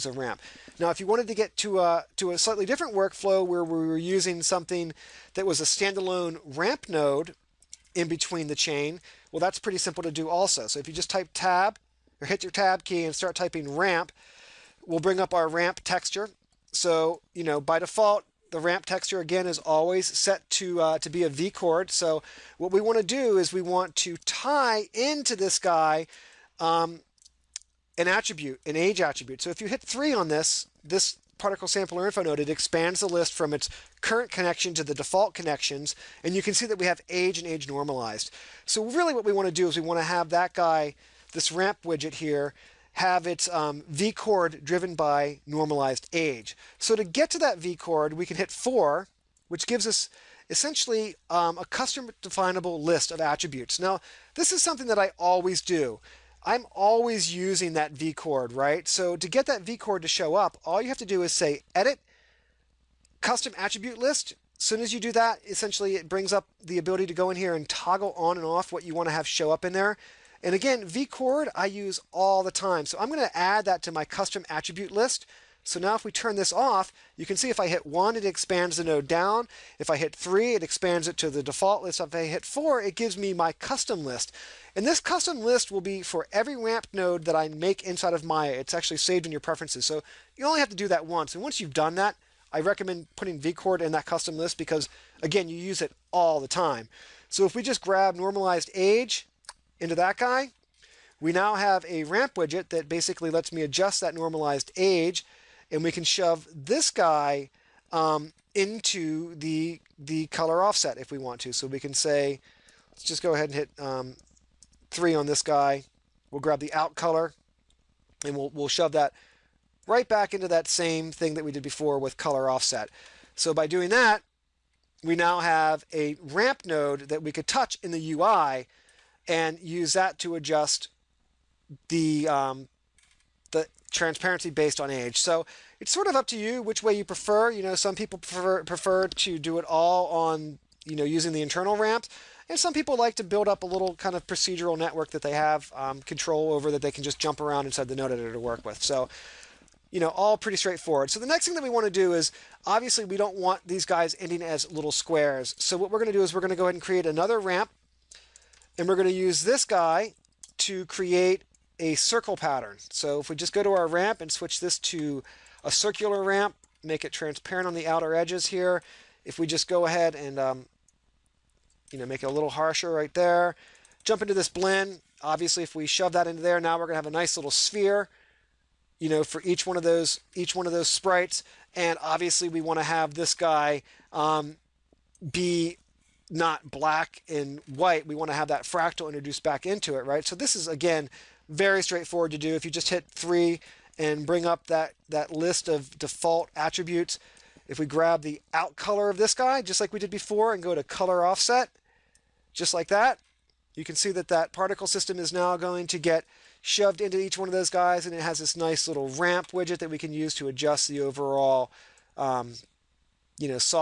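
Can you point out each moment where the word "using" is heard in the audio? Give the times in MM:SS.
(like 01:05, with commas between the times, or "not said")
00:03, 00:57, 02:21.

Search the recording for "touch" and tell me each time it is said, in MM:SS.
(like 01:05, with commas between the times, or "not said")
02:07.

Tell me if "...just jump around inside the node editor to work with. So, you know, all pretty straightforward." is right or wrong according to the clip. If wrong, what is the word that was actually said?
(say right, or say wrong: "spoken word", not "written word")
right.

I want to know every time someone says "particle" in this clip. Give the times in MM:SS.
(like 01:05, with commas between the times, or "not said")
00:31, 03:24.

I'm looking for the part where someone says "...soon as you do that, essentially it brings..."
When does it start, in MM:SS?
01:04.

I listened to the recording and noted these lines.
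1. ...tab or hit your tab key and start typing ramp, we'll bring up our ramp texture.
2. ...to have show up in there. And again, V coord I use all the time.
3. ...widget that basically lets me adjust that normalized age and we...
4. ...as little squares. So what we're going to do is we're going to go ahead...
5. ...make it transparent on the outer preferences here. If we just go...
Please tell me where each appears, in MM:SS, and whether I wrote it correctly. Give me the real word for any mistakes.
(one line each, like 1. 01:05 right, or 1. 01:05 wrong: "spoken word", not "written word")
1. 00:11 right
2. 01:09 right
3. 01:42 right
4. 02:34 right
5. 02:46 wrong: "edges", not "preferences".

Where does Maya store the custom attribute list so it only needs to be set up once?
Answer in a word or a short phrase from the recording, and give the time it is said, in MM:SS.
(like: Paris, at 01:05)
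In your preferences, at 01:29.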